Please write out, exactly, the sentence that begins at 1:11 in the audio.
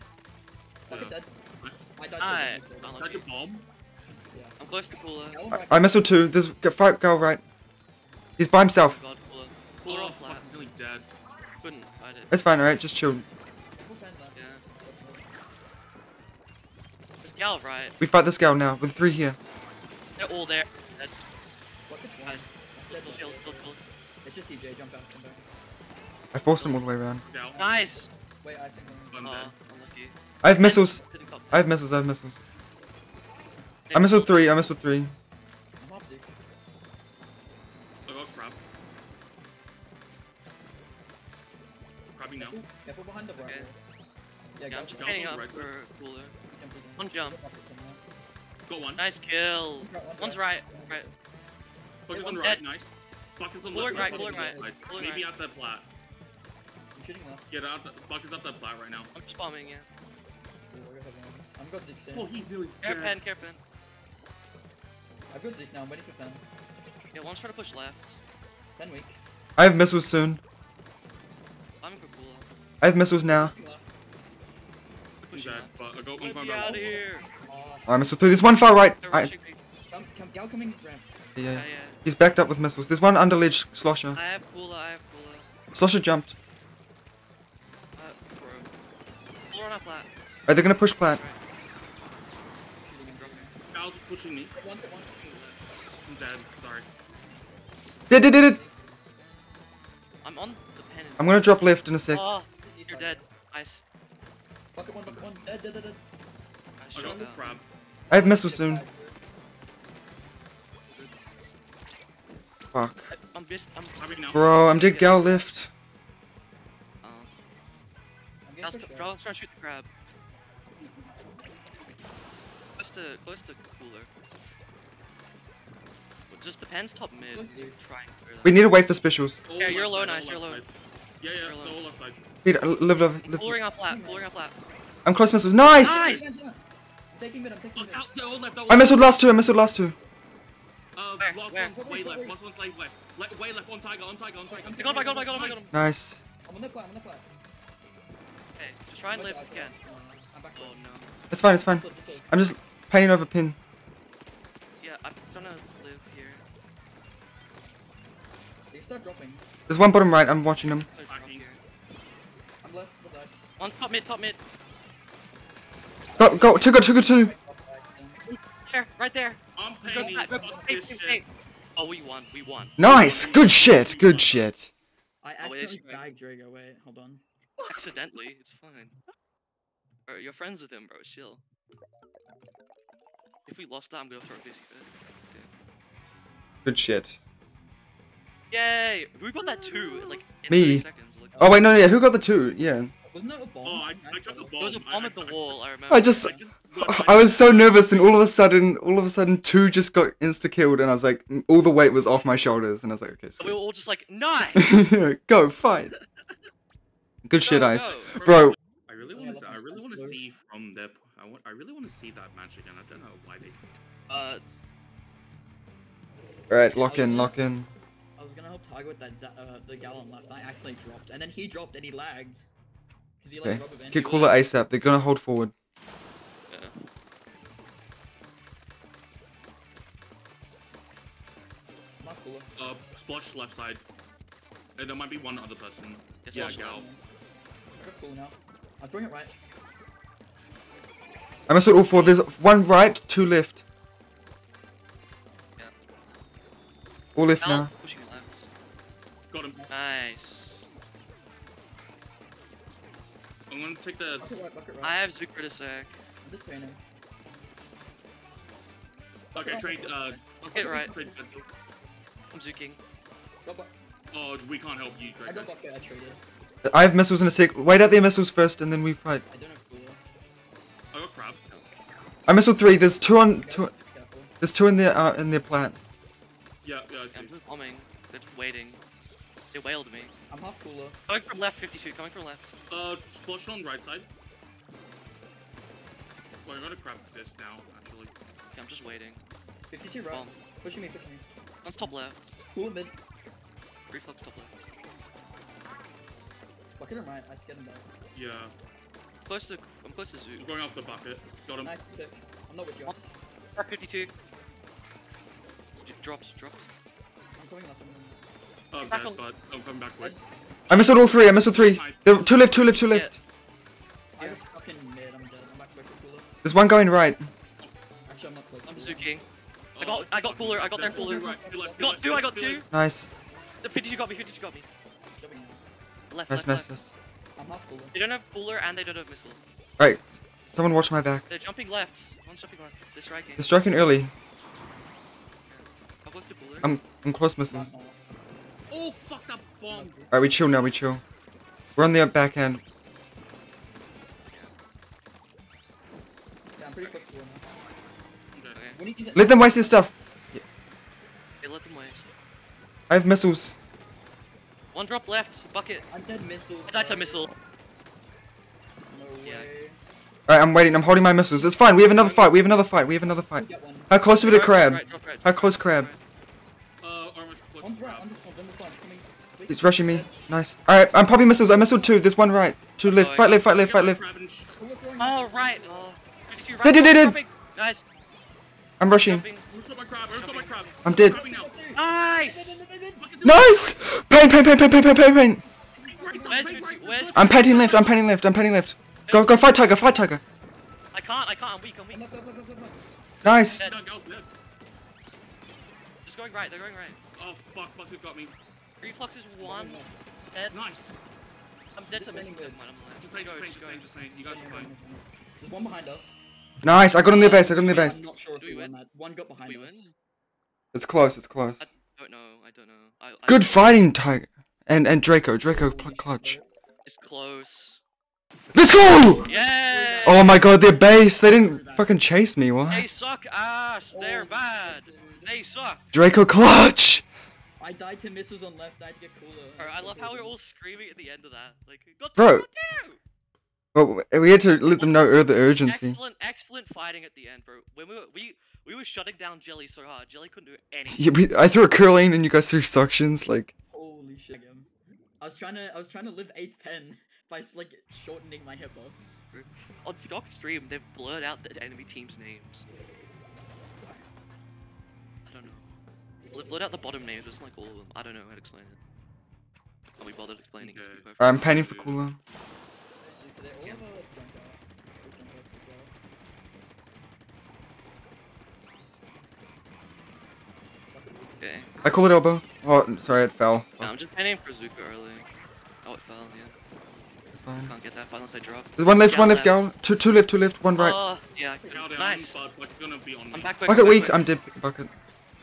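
I'm going cool I have missiles now.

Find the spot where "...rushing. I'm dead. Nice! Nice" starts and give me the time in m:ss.
6:18.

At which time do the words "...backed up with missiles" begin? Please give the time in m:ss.
1:22.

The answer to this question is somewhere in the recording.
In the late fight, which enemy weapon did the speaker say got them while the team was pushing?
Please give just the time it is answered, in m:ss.
6:37.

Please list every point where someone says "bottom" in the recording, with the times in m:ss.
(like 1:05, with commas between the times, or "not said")
2:39, 7:36.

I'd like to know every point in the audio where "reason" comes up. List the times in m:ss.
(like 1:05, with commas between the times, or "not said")
not said.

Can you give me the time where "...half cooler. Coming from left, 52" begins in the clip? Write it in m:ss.
4:40.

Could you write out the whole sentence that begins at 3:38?
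I was gonna help Tiger with that uh, the Gallon left, I accidentally dropped.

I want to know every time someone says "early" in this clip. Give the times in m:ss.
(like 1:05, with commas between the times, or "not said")
5:33, 7:54.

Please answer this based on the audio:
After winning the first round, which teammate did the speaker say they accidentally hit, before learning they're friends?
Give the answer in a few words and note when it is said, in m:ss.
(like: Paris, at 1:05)
Drago, at 2:55.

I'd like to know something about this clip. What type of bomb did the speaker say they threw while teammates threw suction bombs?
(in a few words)
Curling.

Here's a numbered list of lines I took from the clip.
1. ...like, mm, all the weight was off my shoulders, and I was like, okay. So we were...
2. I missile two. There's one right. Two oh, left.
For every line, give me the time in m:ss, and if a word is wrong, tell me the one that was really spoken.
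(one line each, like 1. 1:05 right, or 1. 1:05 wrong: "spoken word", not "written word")
1. 3:21 right
2. 6:11 right.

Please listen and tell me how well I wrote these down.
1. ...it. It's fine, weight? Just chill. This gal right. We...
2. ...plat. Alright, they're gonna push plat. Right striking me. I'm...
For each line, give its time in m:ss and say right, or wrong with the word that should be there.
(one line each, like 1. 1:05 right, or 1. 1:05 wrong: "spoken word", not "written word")
1. 0:12 wrong: "alright", not "weight"
2. 1:29 wrong: "pushing", not "striking".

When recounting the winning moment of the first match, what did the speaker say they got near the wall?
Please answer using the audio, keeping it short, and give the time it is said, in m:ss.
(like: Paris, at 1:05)
The bomb, at 3:13.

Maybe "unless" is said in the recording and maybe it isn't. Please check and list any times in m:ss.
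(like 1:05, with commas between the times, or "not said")
7:58.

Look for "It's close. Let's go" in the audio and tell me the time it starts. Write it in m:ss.
6:56.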